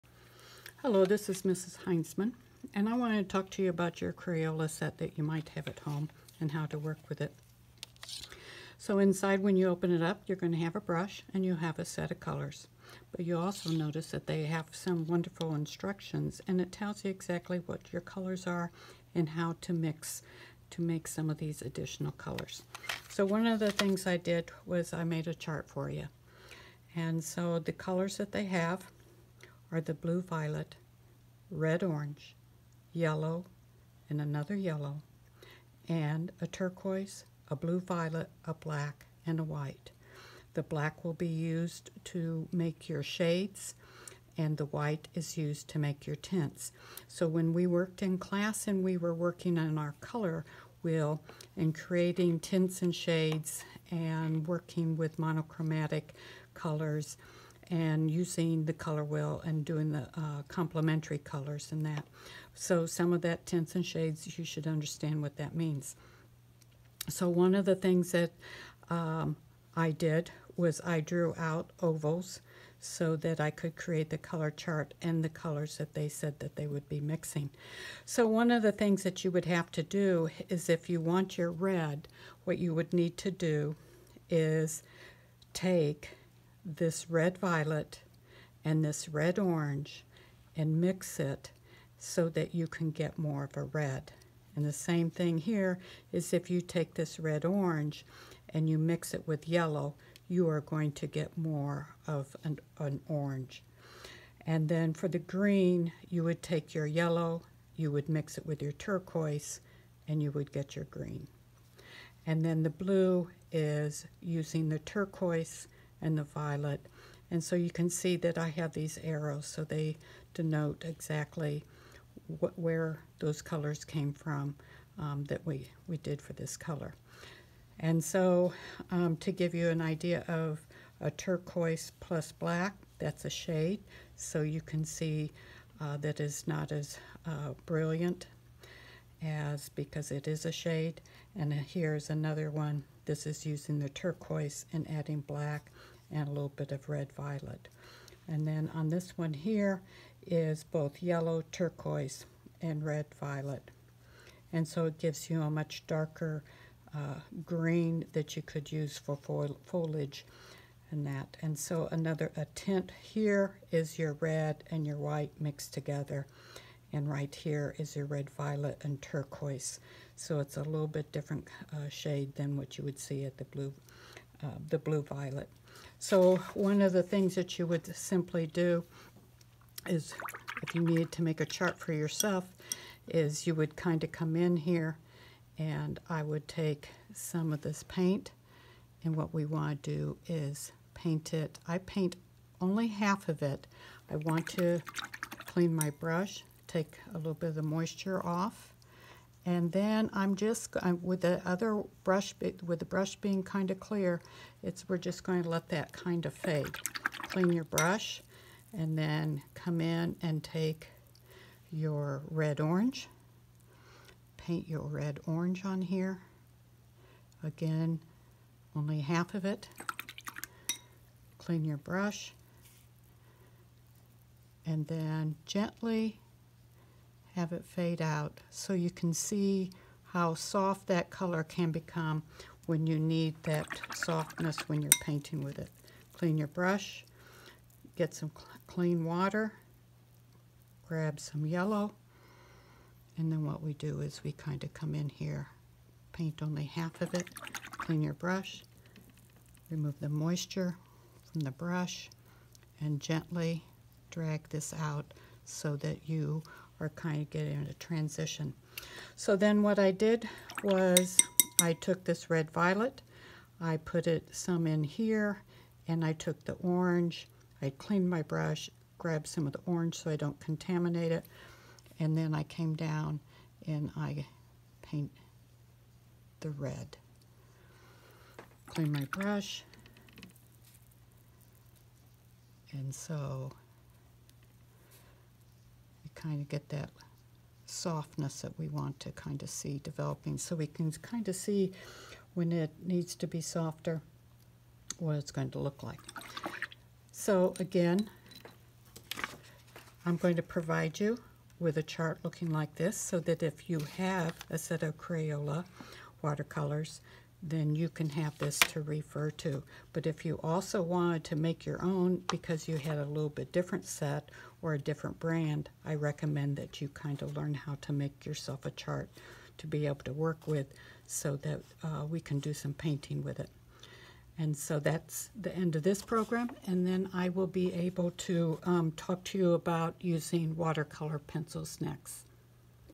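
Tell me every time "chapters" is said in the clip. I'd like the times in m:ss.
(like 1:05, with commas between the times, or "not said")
not said.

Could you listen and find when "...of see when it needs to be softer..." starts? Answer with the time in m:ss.
4:51.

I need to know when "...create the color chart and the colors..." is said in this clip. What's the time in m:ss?
1:13.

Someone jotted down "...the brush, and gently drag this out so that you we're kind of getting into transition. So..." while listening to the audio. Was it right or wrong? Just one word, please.
right.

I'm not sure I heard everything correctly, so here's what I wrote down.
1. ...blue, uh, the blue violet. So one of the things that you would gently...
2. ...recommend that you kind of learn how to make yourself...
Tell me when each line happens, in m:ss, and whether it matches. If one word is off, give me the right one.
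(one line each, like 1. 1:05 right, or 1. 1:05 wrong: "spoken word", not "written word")
1. 2:53 wrong: "simply", not "gently"
2. 5:15 right.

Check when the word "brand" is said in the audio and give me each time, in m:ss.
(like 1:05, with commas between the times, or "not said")
5:15.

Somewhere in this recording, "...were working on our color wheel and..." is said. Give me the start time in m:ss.
0:48.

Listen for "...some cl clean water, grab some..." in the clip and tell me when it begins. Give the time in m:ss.
3:58.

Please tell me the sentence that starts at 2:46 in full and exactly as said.
And right here is your red violet and turquoise.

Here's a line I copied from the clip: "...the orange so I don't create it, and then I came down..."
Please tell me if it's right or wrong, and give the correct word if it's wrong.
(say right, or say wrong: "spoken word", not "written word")
wrong: "contaminate", not "create".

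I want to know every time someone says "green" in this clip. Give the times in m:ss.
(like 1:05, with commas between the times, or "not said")
1:45, 1:50, 2:37.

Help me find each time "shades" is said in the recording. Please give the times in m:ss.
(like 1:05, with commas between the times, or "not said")
0:43, 0:52, 1:03, 2:13, 2:20, 2:51.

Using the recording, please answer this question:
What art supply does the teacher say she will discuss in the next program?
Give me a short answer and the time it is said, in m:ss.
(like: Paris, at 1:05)
Watercolor pencils, at 5:30.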